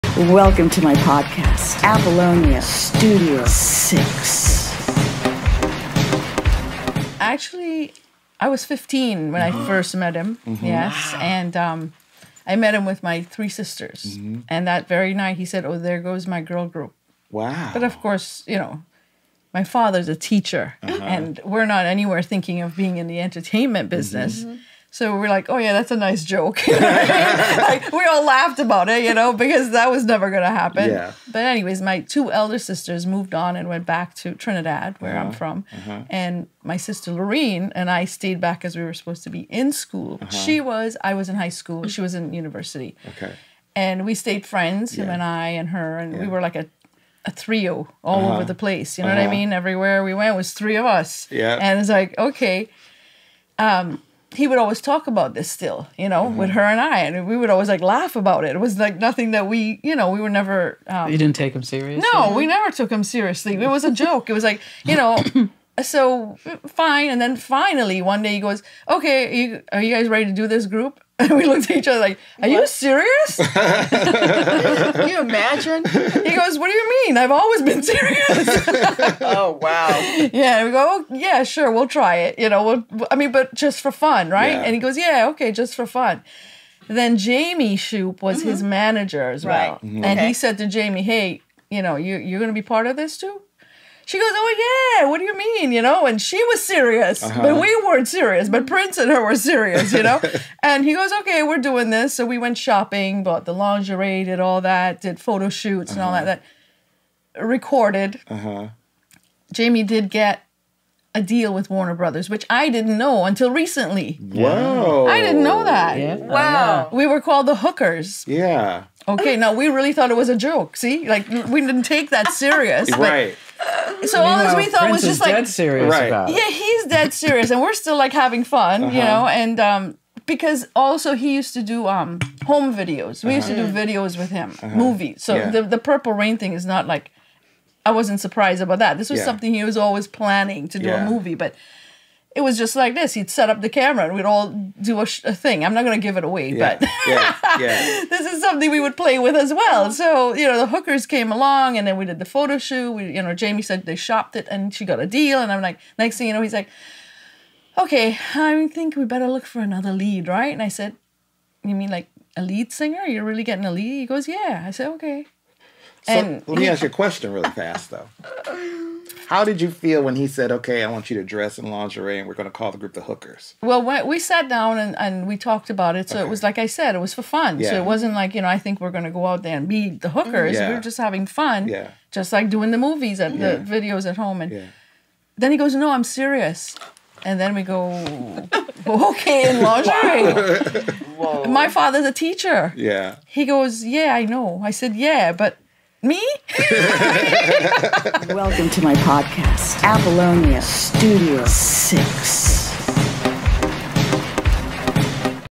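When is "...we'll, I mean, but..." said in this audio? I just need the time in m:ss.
1:22.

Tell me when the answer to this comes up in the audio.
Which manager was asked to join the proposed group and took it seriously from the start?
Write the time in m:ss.
1:27.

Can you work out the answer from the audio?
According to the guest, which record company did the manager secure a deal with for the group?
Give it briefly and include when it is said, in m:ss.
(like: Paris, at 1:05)
Warner Brothers, at 1:51.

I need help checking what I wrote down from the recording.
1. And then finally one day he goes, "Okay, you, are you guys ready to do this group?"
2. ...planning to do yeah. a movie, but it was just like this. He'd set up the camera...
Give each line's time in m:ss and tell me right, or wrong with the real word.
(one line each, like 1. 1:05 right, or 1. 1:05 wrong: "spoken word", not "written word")
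1. 1:07 right
2. 2:20 right.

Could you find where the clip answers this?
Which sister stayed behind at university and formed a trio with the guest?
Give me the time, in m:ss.
0:37.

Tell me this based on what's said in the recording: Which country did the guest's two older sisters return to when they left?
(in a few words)
Trinidad.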